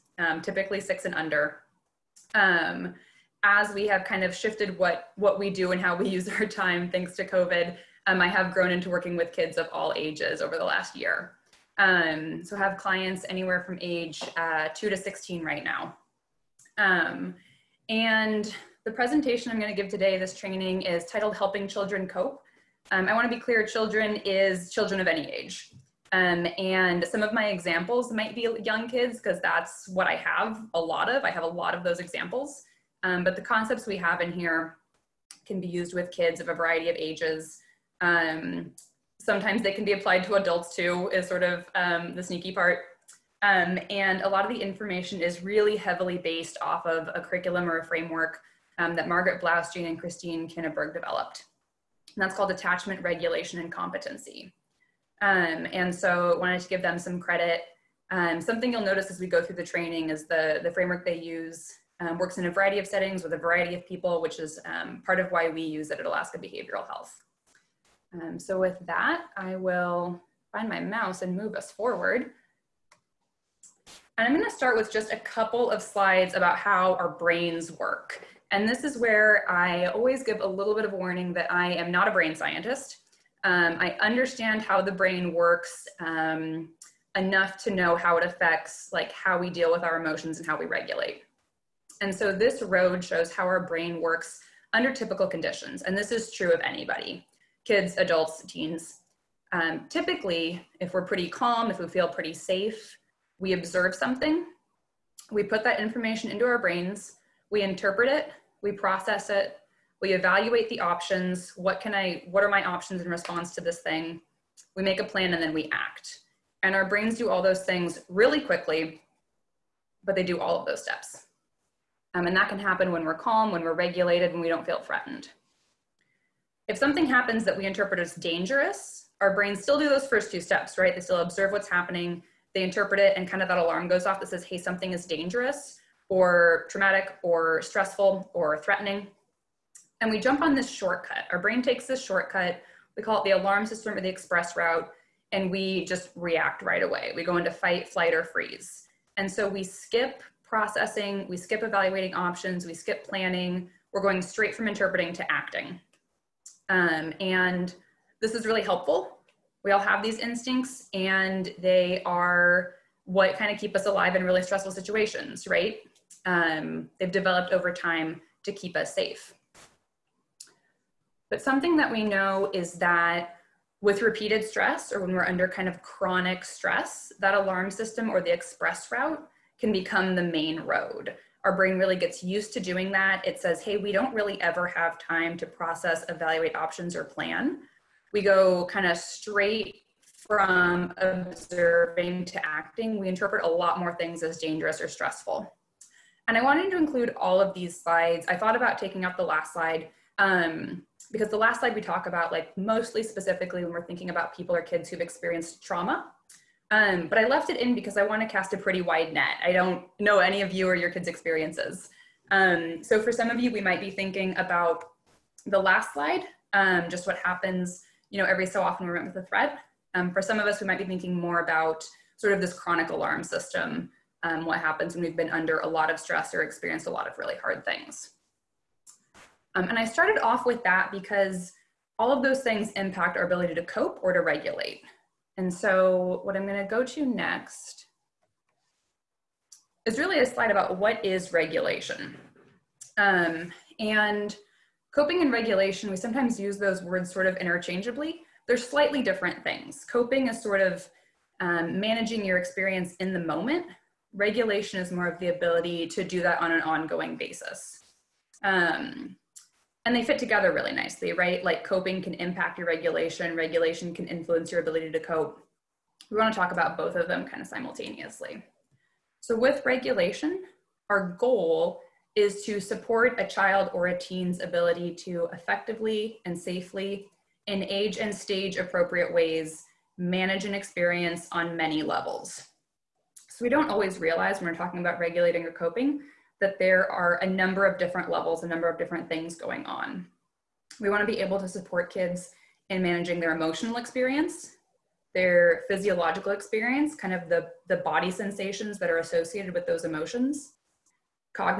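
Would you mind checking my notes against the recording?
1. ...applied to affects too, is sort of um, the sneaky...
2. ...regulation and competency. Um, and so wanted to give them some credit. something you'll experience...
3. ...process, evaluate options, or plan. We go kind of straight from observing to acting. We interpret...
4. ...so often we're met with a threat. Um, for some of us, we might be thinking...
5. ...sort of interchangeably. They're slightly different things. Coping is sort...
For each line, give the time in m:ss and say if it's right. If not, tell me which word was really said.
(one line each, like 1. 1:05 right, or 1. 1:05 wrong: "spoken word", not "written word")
1. 0:39 wrong: "adults", not "affects"
2. 0:53 wrong: "notice", not "experience"
3. 3:05 right
4. 3:38 right
5. 4:07 right.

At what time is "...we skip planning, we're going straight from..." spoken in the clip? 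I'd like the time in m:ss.
2:32.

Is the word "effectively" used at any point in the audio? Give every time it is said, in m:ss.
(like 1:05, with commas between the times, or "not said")
4:35.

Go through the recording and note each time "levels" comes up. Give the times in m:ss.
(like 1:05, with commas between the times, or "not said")
4:41, 4:48.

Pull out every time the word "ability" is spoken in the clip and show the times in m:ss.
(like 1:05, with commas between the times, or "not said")
3:53, 4:15, 4:24, 4:34.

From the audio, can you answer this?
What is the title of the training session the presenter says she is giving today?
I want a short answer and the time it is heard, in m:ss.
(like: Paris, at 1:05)
Helping Children Cope, at 0:21.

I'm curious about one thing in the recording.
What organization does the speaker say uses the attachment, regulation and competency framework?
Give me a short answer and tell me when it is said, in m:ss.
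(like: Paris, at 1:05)
Alaska Behavioral Health, at 1:06.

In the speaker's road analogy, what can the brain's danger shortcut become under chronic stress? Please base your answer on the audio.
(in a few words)
the main road.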